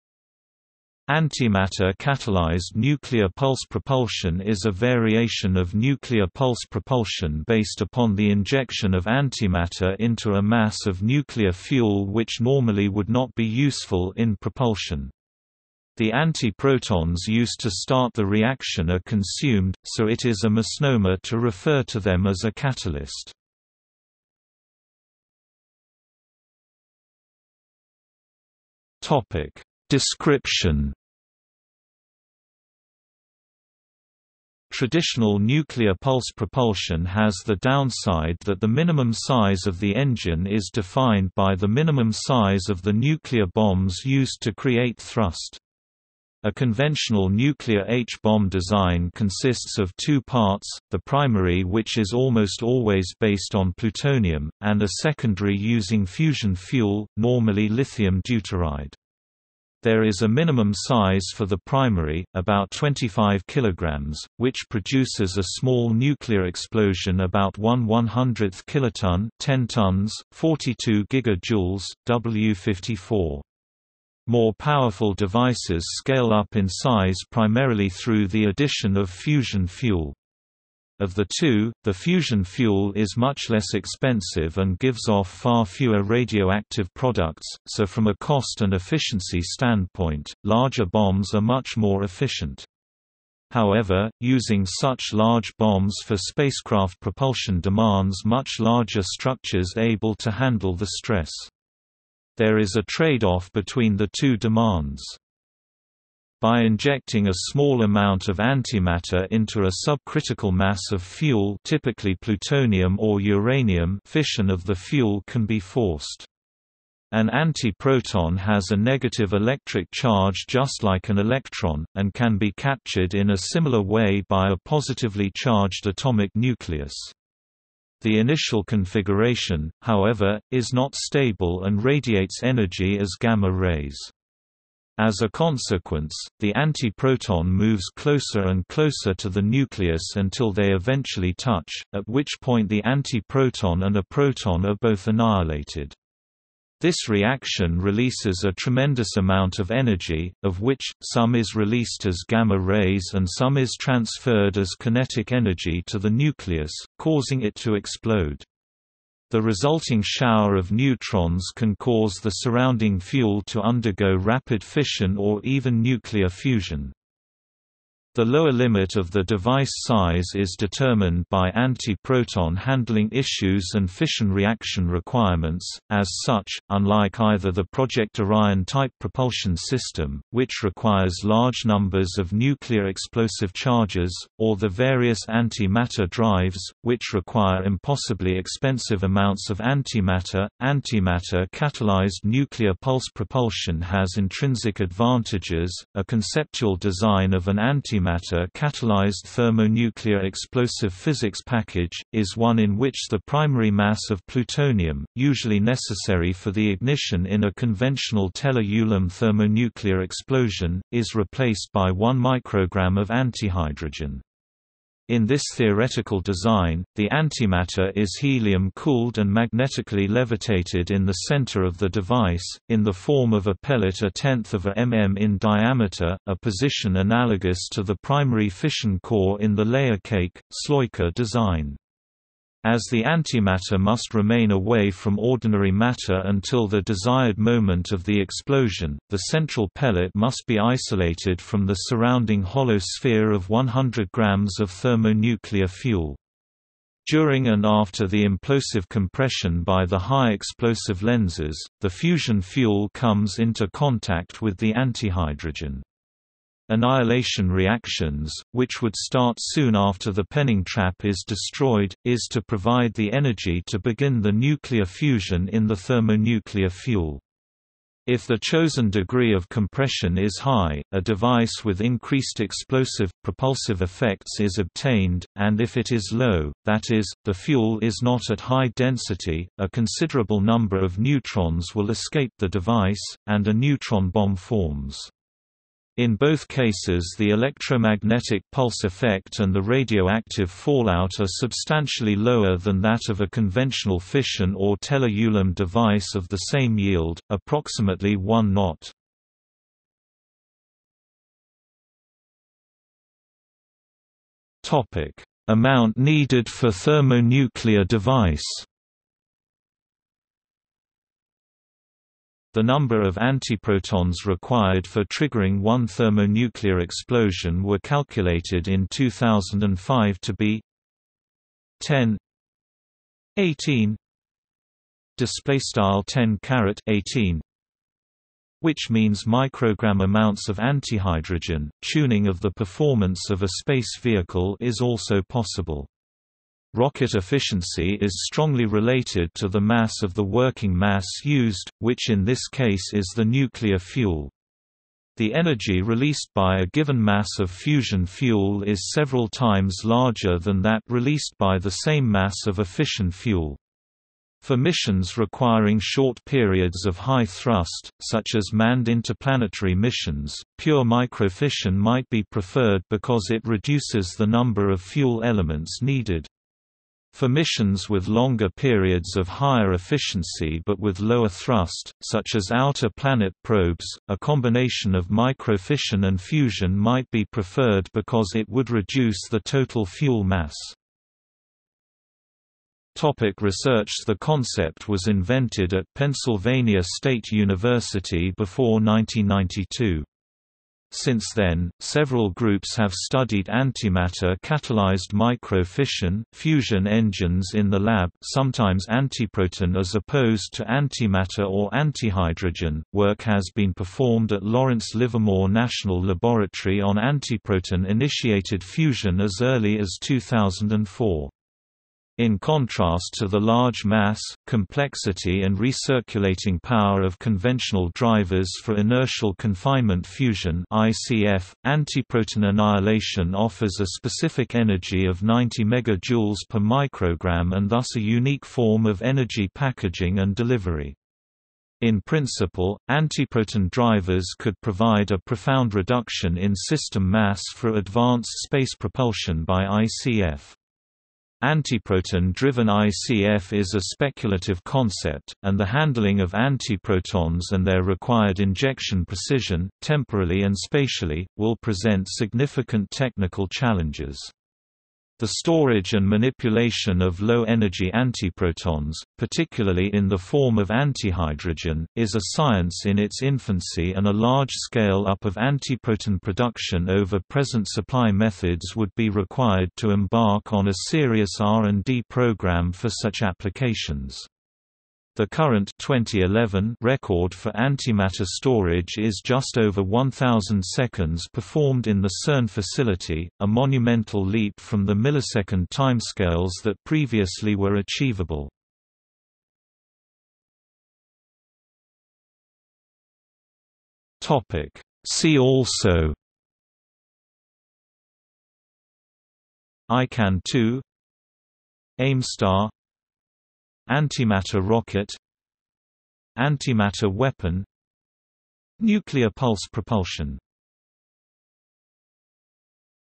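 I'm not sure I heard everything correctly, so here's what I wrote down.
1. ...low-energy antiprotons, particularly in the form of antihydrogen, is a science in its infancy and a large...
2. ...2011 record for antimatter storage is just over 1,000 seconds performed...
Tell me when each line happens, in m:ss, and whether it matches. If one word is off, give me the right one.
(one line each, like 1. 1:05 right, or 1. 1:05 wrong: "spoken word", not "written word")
1. 7:37 right
2. 7:55 right.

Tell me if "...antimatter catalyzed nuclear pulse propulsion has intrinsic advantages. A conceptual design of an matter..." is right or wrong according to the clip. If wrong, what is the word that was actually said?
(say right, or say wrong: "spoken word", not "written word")
wrong: "antimatter", not "matter".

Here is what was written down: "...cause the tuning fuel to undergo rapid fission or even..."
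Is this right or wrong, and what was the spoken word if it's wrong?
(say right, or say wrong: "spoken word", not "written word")
wrong: "surrounding", not "tuning".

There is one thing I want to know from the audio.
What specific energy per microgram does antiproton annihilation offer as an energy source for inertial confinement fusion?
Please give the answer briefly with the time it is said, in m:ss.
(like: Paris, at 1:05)
90 megajoules, at 7:05.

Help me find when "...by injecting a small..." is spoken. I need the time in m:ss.
1:46.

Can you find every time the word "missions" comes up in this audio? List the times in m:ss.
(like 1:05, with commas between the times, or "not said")
5:54, 5:59, 6:07.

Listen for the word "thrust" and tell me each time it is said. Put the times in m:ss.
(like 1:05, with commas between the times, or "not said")
0:44, 5:57, 6:11.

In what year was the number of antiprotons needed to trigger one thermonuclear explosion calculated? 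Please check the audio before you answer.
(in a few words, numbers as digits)
2005.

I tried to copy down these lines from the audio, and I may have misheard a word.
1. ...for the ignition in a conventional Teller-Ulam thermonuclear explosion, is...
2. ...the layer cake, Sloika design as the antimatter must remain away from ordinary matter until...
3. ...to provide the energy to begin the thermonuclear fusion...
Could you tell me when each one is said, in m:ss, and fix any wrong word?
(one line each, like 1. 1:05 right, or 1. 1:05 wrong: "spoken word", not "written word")
1. 3:26 right
2. 3:49 right
3. 4:22 wrong: "nuclear", not "thermonuclear".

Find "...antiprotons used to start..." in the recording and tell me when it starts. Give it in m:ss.
0:16.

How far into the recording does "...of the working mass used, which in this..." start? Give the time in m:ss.
5:40.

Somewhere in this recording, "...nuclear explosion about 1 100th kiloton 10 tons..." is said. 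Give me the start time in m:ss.
1:05.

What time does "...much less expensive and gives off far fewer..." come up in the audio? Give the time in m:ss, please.
1:23.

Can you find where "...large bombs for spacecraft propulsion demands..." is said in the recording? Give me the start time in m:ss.
1:35.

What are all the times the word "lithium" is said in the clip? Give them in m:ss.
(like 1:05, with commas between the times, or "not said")
0:57.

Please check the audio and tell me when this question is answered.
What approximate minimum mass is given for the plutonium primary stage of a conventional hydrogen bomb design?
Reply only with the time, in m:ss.
1:02.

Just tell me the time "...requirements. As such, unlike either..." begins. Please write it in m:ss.
2:54.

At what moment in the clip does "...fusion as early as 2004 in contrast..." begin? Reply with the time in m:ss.
6:48.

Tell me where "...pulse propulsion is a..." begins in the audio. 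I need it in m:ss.
0:03.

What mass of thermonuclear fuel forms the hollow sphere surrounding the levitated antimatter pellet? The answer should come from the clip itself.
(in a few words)
100 grams.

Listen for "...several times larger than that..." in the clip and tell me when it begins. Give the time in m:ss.
5:48.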